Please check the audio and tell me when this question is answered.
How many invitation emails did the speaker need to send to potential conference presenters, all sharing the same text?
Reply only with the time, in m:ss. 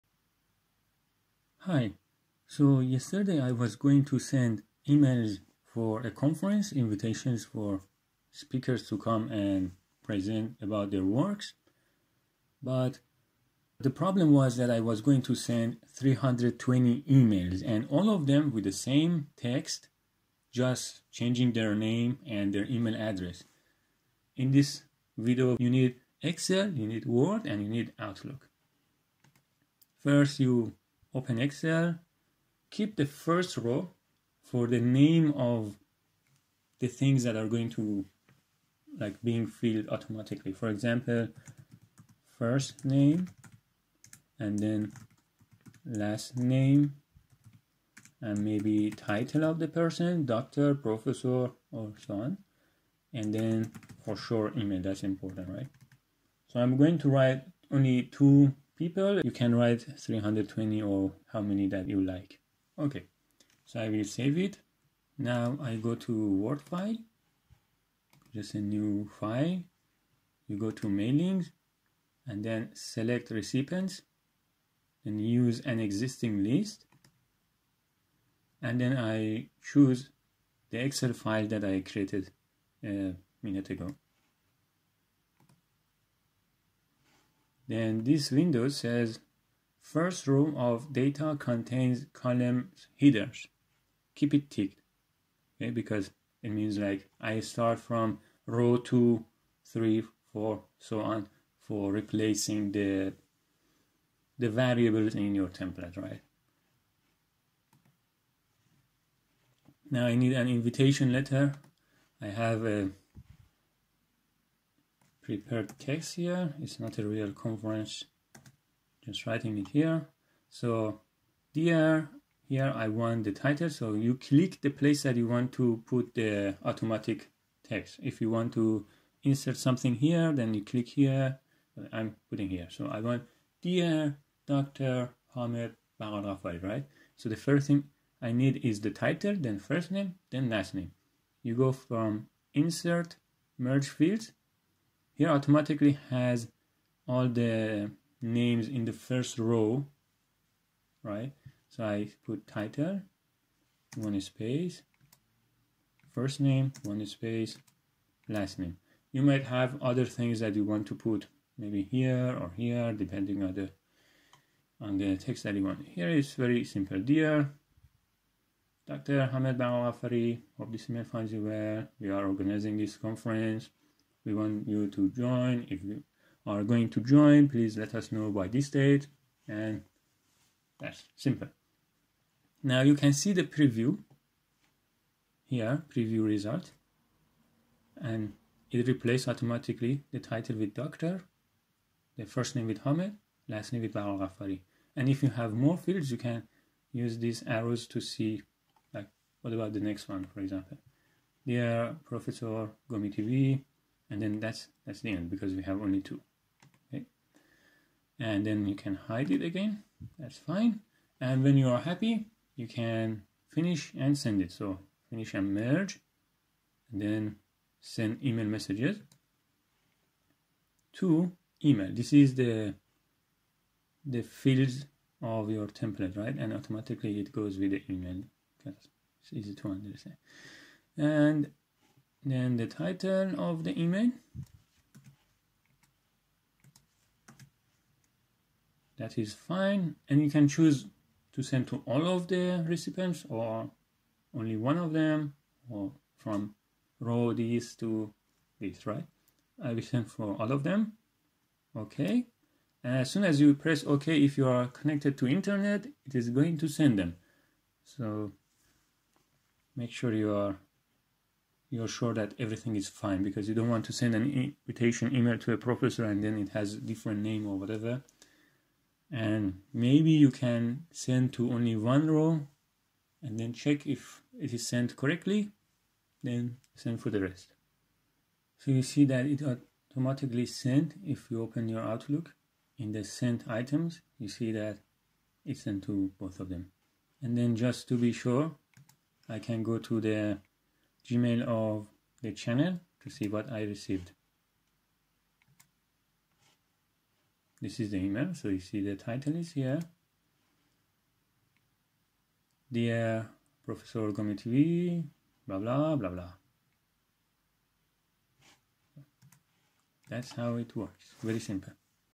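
0:15.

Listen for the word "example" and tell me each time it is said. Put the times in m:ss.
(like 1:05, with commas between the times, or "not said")
0:40, 3:20.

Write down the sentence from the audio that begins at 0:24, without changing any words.
In this video, you need Excel, you need Word, and you need Outlook.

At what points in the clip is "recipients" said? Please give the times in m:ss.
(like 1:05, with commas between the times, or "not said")
1:13, 4:02.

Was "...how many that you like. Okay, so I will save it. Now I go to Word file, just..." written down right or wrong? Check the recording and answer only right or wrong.
right.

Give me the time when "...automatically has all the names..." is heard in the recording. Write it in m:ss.
2:25.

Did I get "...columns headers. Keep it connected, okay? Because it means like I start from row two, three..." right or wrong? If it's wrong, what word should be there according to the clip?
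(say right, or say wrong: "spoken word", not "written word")
wrong: "ticked", not "connected".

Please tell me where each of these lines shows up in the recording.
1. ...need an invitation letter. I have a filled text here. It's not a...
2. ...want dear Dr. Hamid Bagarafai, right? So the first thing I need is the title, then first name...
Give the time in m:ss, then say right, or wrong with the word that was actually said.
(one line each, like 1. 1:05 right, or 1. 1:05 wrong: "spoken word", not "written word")
1. 1:50 wrong: "prepared", not "filled"
2. 2:12 right.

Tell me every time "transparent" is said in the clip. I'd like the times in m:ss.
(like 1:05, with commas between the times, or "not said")
not said.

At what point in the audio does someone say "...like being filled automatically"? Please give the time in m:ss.
0:38.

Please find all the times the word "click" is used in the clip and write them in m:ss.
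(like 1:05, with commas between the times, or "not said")
2:04, 2:10.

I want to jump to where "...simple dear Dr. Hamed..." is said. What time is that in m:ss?
2:46.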